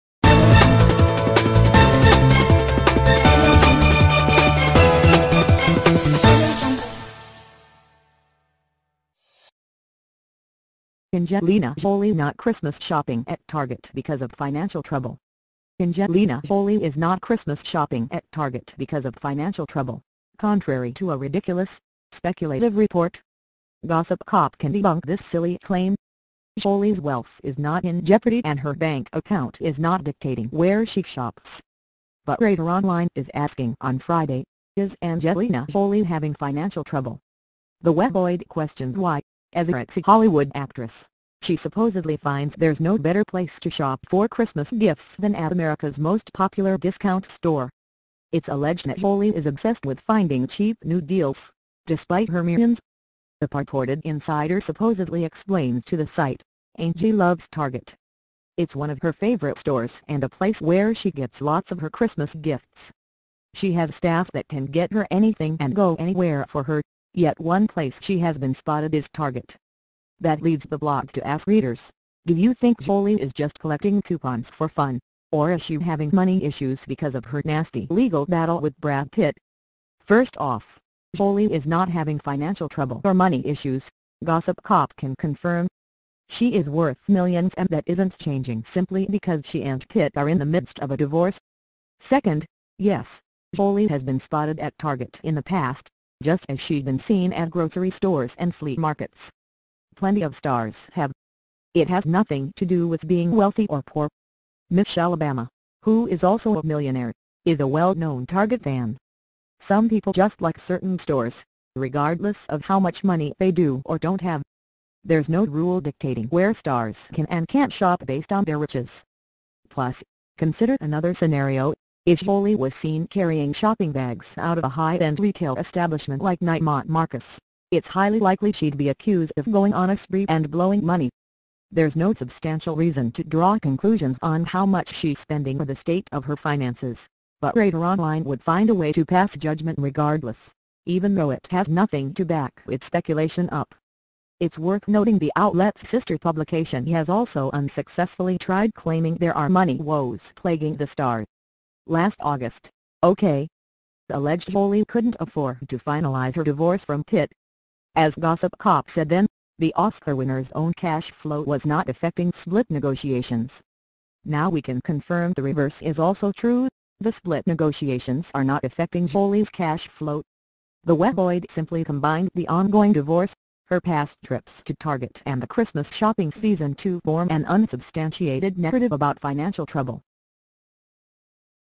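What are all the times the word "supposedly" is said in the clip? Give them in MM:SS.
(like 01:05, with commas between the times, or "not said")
00:41, 00:54.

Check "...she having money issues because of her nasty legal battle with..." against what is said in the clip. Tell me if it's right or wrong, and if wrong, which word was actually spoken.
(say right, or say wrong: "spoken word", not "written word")
right.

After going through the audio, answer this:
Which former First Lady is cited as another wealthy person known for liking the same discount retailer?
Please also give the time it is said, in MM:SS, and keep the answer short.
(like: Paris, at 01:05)
Michelle Obama, at 01:44.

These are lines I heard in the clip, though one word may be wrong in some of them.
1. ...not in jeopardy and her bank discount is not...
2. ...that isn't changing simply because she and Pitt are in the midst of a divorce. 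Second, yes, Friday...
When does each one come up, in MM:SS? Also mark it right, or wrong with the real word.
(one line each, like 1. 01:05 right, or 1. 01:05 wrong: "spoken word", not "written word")
1. 00:27 wrong: "account", not "discount"
2. 01:27 wrong: "Jolie", not "Friday".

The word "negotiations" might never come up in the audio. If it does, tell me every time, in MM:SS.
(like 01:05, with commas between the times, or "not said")
02:42, 02:47.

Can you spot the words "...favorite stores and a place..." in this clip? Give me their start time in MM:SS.
00:59.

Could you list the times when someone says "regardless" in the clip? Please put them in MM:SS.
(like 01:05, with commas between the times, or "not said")
01:51, 02:19.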